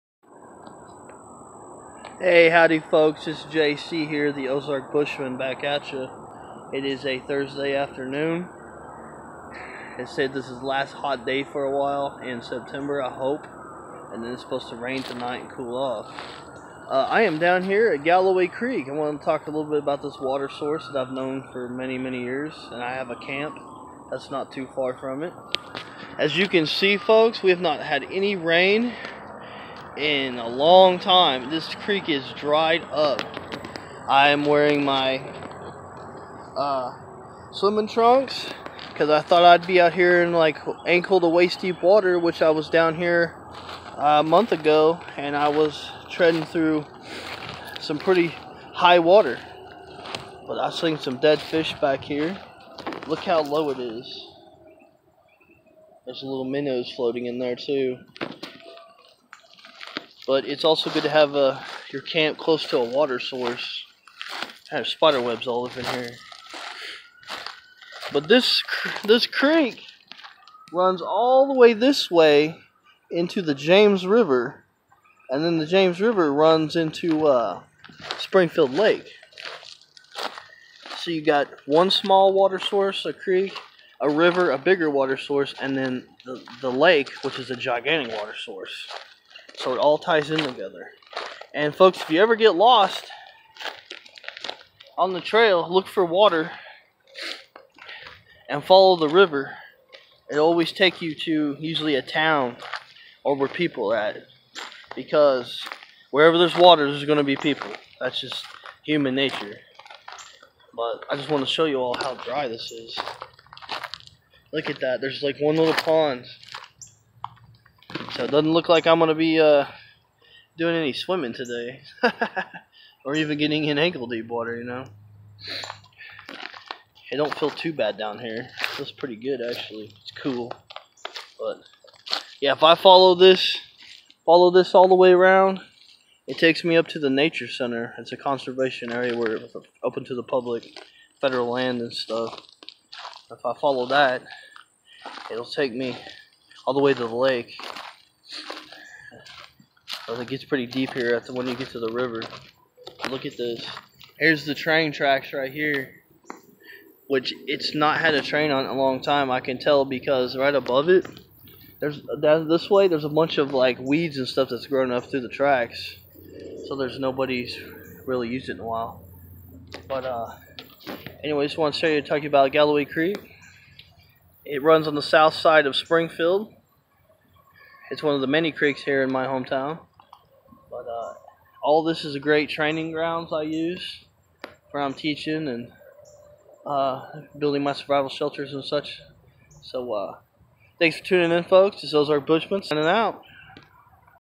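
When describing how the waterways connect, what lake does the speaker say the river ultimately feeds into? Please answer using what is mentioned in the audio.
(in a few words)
Springfield Lake.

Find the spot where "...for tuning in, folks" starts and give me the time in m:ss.
3:10.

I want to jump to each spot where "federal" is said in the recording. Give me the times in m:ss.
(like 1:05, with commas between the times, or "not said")
2:21.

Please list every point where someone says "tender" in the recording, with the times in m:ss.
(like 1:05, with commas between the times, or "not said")
not said.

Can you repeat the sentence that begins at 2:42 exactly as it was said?
There's a bunch of like weeds and stuff that's grown up through the tracks.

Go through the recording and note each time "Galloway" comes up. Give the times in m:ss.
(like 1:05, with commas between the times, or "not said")
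0:18, 2:52.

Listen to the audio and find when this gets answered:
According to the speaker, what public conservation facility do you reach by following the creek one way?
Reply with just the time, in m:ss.
2:17.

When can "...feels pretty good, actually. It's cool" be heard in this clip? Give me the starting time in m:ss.
2:08.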